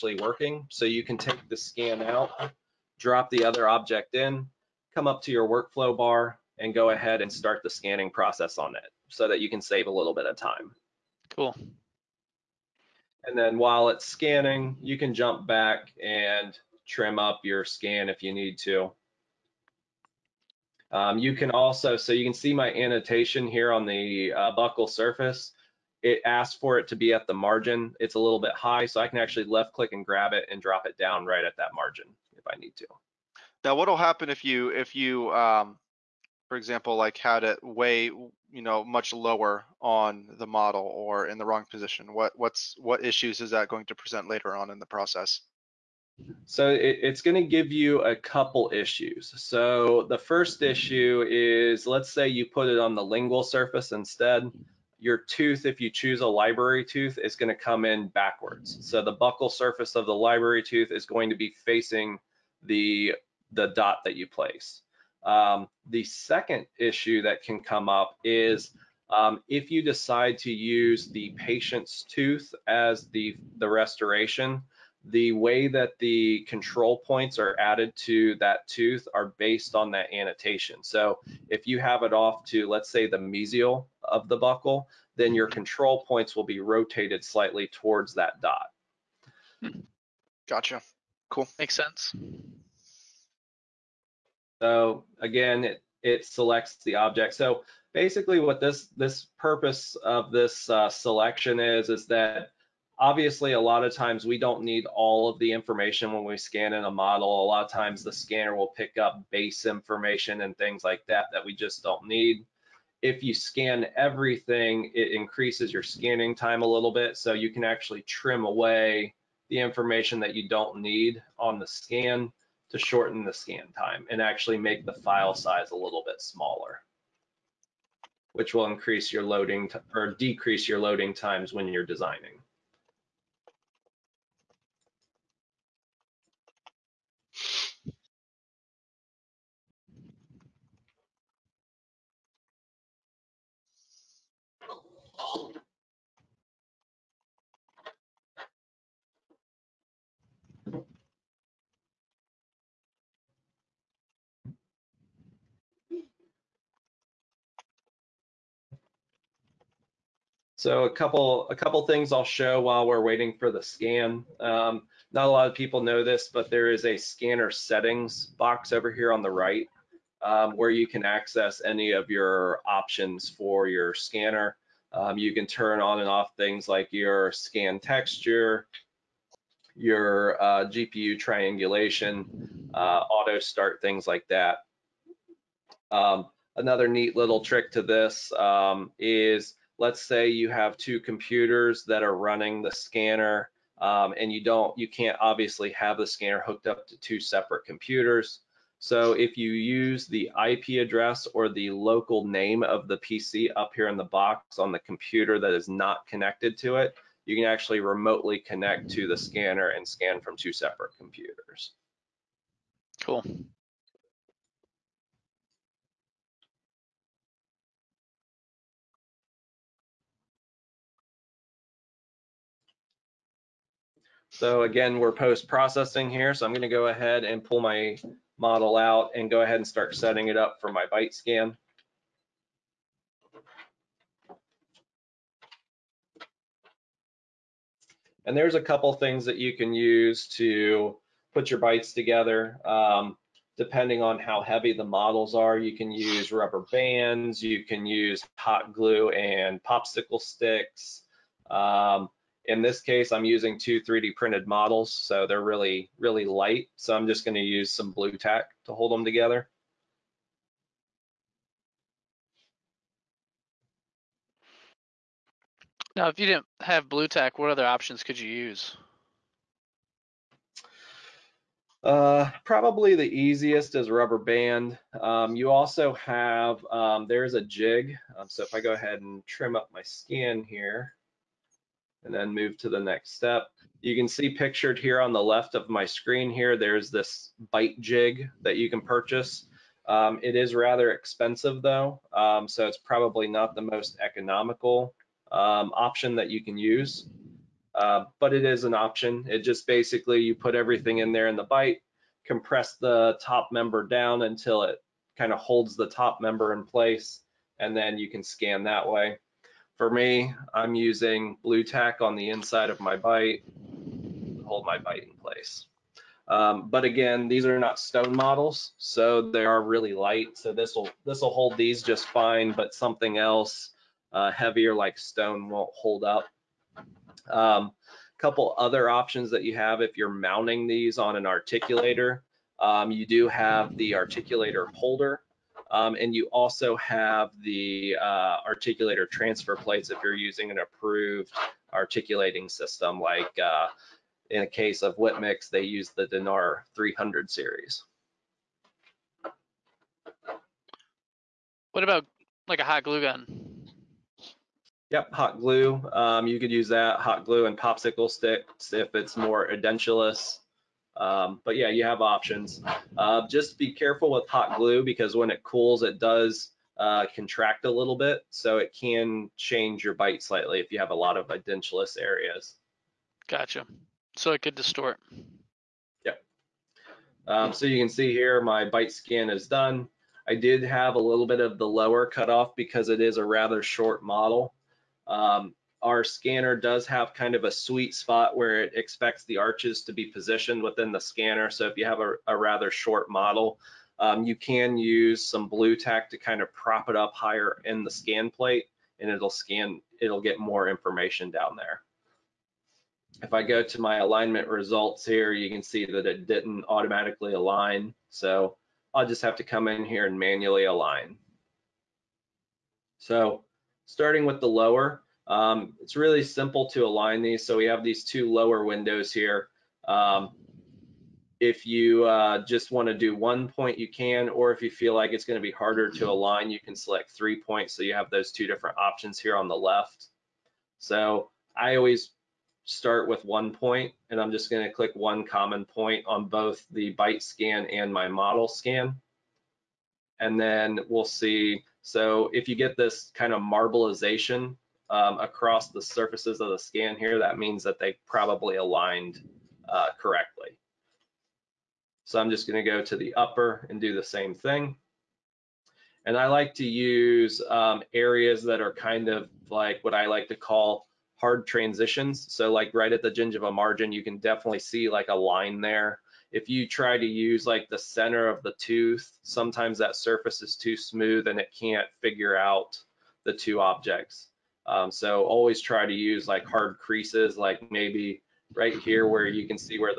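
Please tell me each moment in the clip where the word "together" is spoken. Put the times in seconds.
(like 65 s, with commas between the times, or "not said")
241 s, 259 s.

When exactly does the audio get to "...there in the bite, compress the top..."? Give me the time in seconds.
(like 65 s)
301 s.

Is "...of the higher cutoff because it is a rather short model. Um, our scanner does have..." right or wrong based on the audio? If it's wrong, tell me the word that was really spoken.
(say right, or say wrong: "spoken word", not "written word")
wrong: "lower", not "higher".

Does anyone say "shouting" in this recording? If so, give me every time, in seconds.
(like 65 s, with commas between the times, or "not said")
not said.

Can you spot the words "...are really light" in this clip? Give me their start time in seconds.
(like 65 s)
319 s.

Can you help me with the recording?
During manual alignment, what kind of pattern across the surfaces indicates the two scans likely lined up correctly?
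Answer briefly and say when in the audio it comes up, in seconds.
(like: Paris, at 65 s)
Marbleization, at 443 s.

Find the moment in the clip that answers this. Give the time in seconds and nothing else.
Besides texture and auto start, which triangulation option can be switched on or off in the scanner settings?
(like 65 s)
180 s.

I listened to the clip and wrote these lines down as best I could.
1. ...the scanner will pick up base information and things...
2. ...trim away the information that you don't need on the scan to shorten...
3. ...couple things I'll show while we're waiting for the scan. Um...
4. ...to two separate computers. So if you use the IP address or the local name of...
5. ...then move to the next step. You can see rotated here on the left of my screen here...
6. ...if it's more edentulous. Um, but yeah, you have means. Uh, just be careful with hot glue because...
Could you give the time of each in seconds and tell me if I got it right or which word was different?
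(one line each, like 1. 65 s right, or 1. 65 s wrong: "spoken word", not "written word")
1. 108 s right
2. 118 s right
3. 161 s right
4. 196 s right
5. 282 s wrong: "pictured", not "rotated"
6. 358 s wrong: "options", not "means".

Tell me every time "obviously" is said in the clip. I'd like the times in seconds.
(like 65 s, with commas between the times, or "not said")
103 s, 195 s.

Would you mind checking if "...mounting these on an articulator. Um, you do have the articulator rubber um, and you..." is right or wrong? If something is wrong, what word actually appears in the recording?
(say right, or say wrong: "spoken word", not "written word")
wrong: "holder", not "rubber".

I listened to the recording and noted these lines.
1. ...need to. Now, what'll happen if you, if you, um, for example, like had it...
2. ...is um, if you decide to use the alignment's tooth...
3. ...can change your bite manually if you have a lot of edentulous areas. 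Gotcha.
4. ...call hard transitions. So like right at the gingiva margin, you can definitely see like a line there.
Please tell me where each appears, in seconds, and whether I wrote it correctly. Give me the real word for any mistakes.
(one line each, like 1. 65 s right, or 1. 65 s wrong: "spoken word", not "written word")
1. 32 s right
2. 68 s wrong: "patient", not "alignment"
3. 368 s wrong: "slightly", not "manually"
4. 460 s right.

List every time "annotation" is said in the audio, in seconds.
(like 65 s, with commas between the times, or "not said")
22 s, 80 s.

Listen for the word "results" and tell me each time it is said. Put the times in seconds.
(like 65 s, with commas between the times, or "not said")
404 s.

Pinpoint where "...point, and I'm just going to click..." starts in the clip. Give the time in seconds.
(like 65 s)
433 s.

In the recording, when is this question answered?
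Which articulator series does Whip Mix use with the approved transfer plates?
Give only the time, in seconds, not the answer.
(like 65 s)
346 s.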